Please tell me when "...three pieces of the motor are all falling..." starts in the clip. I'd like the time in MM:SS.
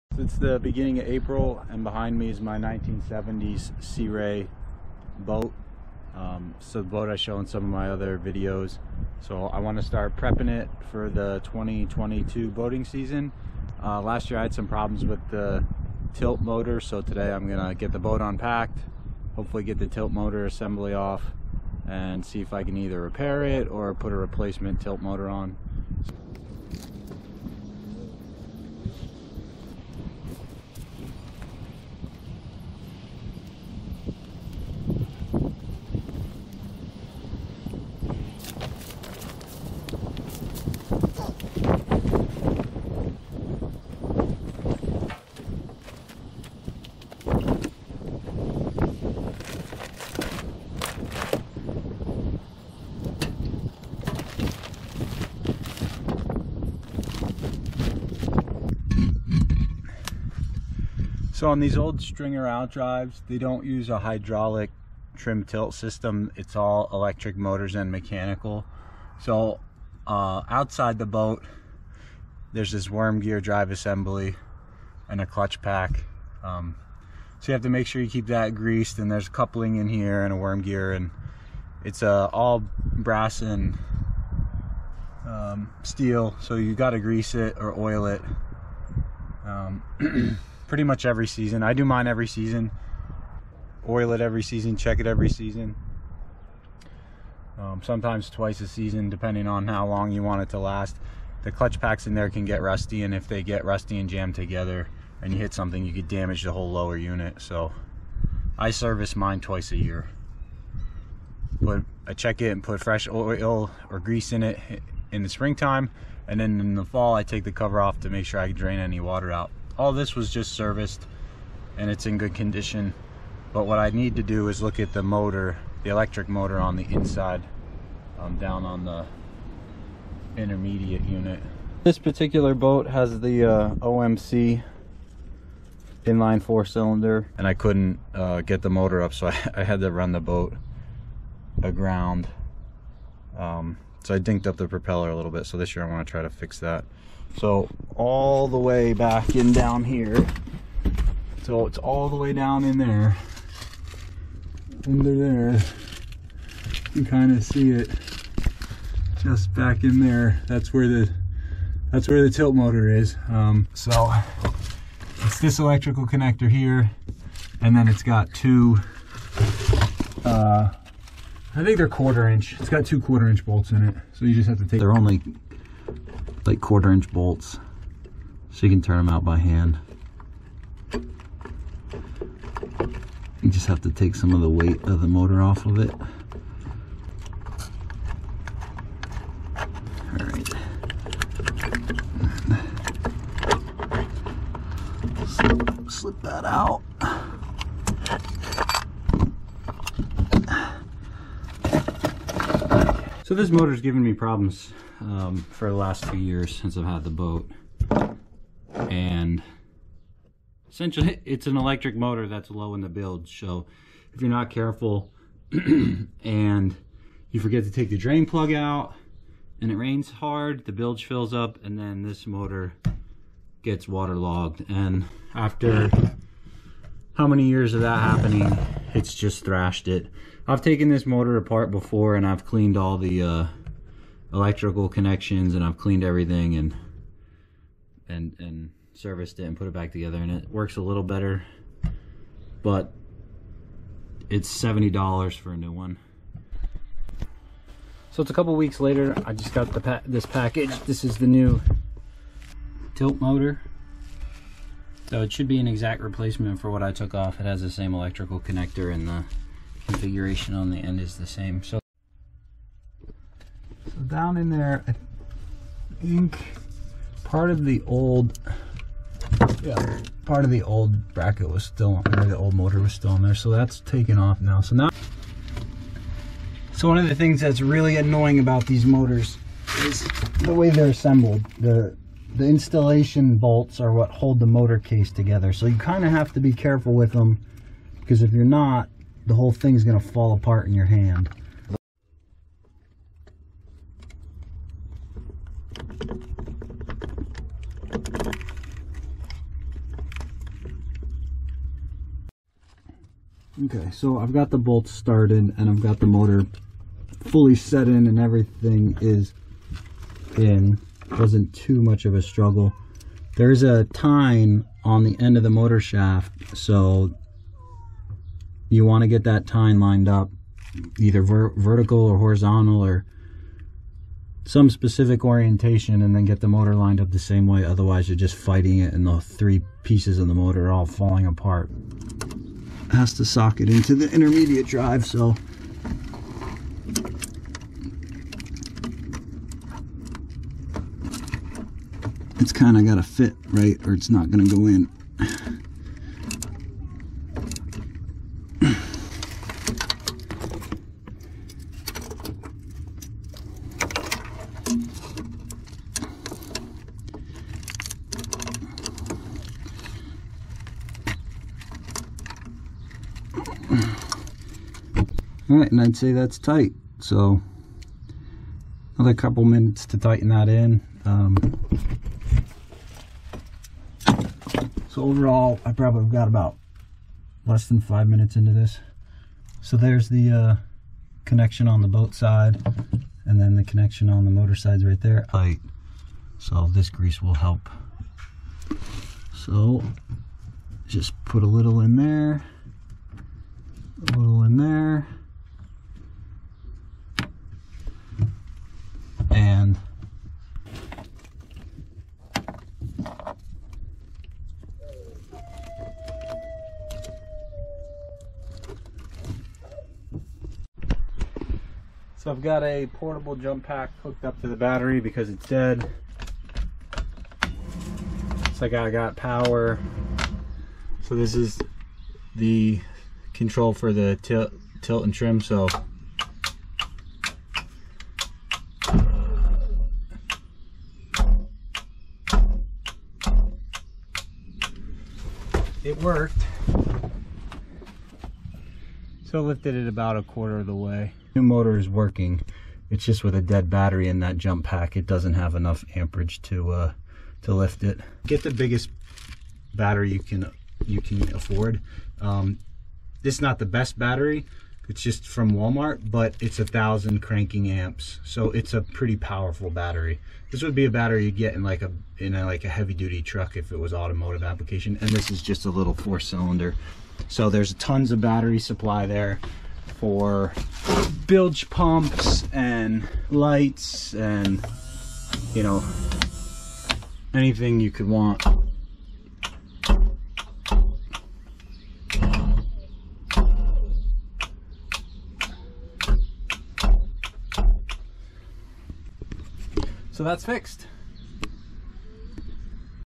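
05:29.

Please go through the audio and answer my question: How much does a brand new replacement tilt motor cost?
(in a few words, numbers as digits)
$70.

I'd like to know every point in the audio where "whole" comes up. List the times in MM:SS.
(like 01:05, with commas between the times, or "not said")
01:46, 04:49.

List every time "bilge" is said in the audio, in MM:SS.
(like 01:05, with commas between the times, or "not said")
03:40, 07:51.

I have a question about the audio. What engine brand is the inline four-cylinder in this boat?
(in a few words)
OMC.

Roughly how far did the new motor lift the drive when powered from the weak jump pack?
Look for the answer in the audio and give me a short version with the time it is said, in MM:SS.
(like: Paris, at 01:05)
a quarter of the way, at 07:20.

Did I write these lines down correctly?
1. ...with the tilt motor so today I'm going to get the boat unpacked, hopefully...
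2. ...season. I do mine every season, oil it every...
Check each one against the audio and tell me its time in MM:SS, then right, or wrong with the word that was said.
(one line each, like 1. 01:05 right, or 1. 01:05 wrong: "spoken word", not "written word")
1. 00:15 right
2. 01:31 right.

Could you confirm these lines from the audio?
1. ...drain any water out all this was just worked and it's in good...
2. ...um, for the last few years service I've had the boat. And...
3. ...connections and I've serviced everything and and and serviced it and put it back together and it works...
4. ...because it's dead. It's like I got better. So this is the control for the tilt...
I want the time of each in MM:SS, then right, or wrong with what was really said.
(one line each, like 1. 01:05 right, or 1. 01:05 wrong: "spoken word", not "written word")
1. 01:58 wrong: "serviced", not "worked"
2. 03:24 wrong: "since", not "service"
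3. 03:54 wrong: "cleaned", not "serviced"
4. 06:54 wrong: "power", not "better".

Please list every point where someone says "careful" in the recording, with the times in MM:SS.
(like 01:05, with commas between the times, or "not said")
03:34, 04:46.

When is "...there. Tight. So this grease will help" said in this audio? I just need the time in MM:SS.
06:25.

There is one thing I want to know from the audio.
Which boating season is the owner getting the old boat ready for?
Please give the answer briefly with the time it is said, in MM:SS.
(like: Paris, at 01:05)
2022, at 00:11.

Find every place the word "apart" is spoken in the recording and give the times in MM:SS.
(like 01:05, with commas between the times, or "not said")
03:51, 04:50, 05:31.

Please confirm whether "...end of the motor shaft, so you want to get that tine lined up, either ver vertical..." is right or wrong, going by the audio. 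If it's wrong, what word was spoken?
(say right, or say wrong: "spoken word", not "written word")
right.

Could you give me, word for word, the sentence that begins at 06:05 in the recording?
All right, and I'd say that's tight.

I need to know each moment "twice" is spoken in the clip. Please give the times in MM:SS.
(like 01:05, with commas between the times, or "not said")
01:38, 01:49.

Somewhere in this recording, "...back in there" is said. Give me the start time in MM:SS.
02:39.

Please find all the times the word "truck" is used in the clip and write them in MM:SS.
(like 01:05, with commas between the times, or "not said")
07:43.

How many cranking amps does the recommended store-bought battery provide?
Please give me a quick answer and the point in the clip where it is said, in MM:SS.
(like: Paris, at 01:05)
1000, at 07:36.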